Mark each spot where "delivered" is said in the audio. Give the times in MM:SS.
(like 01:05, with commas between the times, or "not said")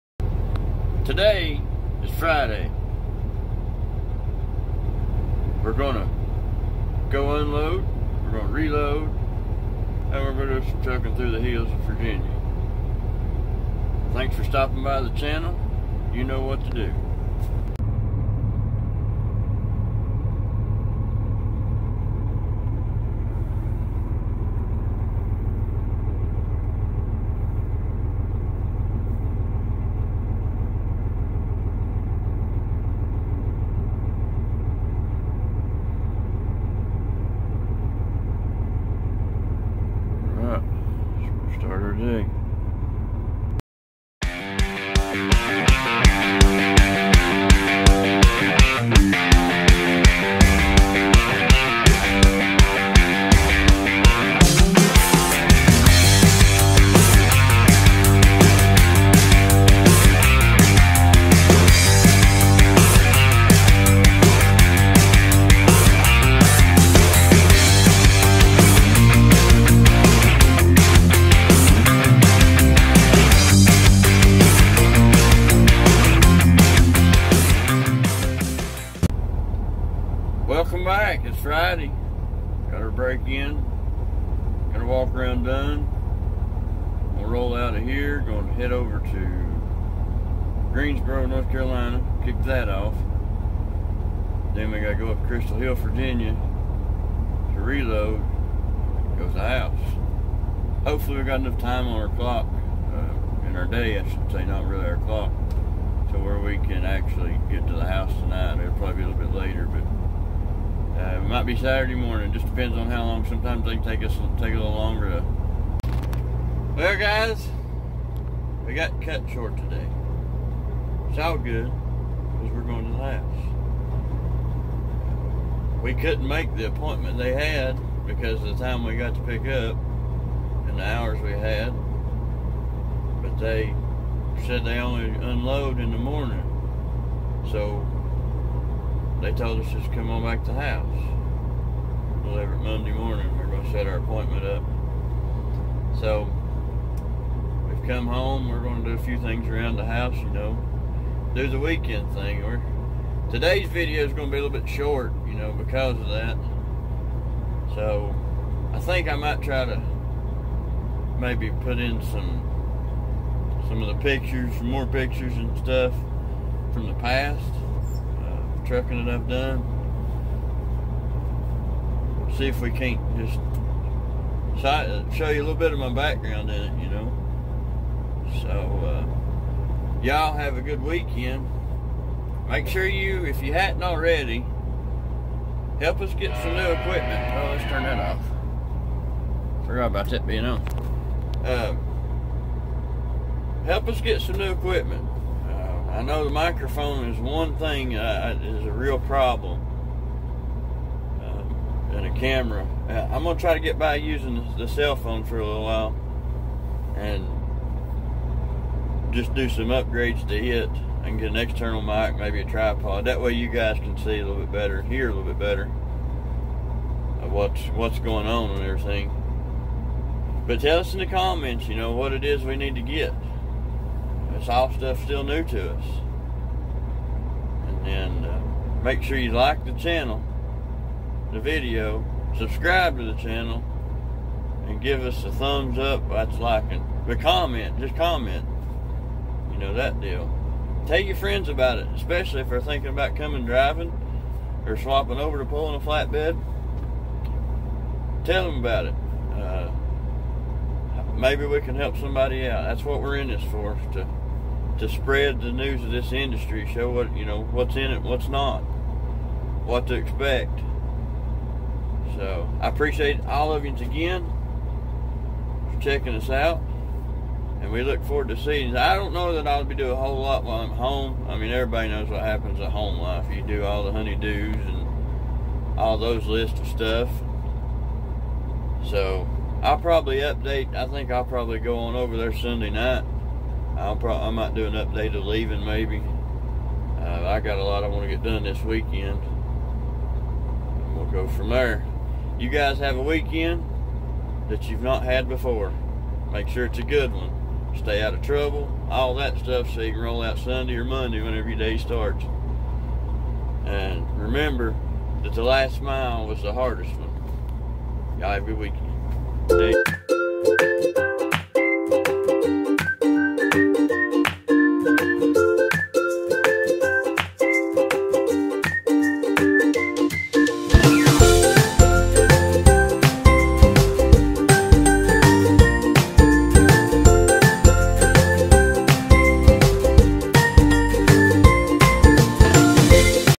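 not said.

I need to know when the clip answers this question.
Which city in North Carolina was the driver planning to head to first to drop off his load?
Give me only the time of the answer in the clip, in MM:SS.
01:30.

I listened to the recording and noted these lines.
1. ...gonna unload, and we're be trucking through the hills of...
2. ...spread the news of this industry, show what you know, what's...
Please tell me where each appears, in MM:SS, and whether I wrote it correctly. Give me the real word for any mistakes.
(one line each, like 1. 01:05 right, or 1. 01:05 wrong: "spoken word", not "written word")
1. 00:08 wrong: "reload", not "unload"
2. 04:14 right.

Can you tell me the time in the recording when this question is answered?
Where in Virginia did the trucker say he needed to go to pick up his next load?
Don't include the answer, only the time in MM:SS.
01:35.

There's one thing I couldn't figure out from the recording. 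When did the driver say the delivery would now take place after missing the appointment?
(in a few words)
Monday morning.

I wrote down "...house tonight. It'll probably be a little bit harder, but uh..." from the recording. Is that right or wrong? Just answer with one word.
wrong.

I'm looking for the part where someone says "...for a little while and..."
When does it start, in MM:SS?
03:25.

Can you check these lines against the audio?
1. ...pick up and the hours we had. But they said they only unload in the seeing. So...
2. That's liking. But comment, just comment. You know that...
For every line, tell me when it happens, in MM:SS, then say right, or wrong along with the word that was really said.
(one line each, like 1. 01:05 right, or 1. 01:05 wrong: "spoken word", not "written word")
1. 02:09 wrong: "morning", not "seeing"
2. 03:56 right.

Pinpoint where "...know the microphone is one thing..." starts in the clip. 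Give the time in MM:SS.
03:16.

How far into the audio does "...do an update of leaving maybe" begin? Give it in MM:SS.
04:44.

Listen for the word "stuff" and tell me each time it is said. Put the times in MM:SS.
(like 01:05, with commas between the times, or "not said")
02:45, 03:44, 04:36, 04:59.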